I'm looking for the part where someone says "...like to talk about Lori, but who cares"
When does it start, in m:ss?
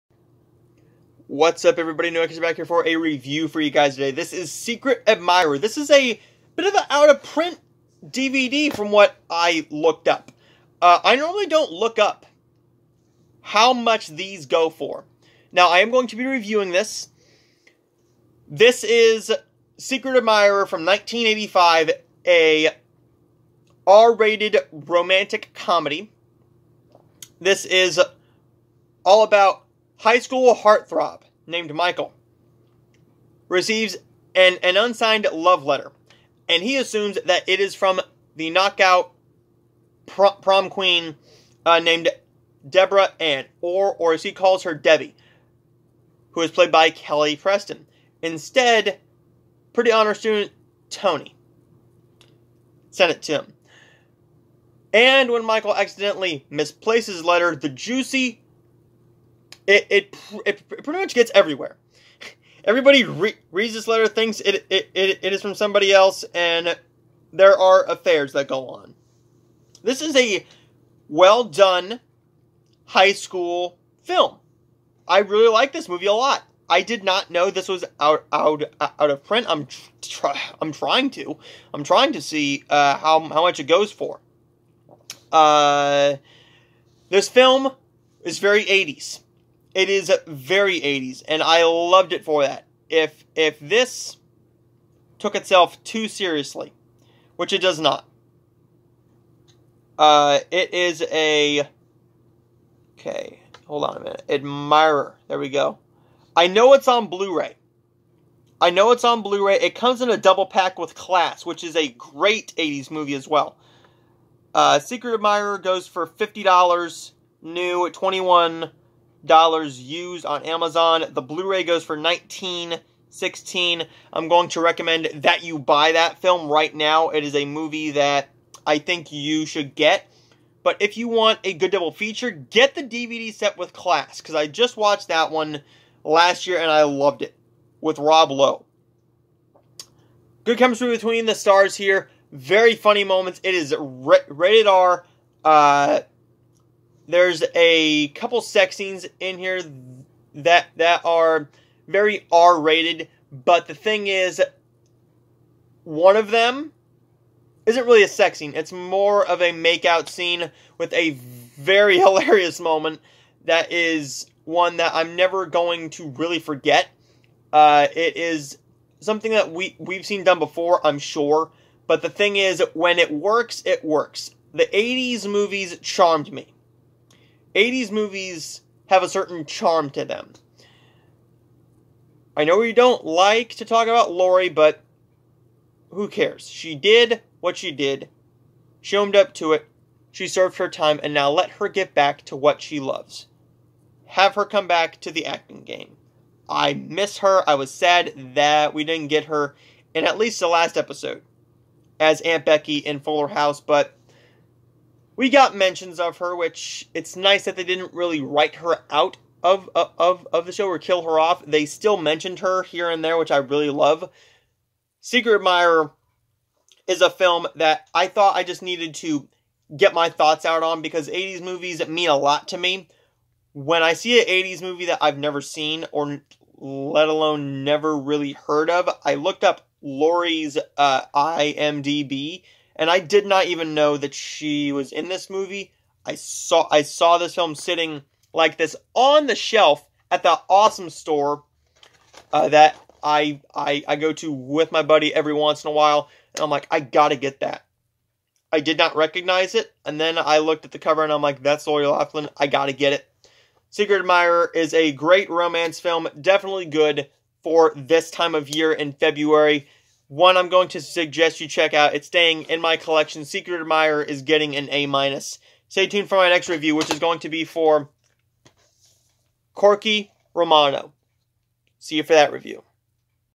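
3:03.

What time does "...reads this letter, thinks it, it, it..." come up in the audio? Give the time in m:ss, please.
1:03.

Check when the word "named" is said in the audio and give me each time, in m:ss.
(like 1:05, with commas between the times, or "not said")
0:31, 0:41.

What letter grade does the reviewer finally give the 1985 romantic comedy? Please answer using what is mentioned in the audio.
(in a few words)
A minus.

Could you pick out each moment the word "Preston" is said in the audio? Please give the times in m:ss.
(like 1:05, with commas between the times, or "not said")
0:47.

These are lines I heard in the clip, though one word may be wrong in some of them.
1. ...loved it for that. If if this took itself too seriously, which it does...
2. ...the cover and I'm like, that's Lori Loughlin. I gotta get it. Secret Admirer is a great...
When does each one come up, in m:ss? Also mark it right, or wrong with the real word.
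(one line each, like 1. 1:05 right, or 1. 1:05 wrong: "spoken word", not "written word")
1. 1:31 right
2. 4:10 right.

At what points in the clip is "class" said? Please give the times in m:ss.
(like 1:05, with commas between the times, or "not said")
1:50, 2:13.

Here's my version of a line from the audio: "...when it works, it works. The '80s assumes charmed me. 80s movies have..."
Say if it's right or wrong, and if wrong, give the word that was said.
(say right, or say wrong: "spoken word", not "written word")
wrong: "movies", not "assumes".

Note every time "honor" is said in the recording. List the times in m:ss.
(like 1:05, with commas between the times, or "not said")
0:49.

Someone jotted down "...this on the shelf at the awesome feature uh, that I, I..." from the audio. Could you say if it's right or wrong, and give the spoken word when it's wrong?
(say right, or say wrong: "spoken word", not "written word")
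wrong: "store", not "feature".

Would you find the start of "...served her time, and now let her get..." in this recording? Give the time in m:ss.
3:10.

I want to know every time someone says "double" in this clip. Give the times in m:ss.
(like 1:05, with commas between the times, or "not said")
1:50, 2:11.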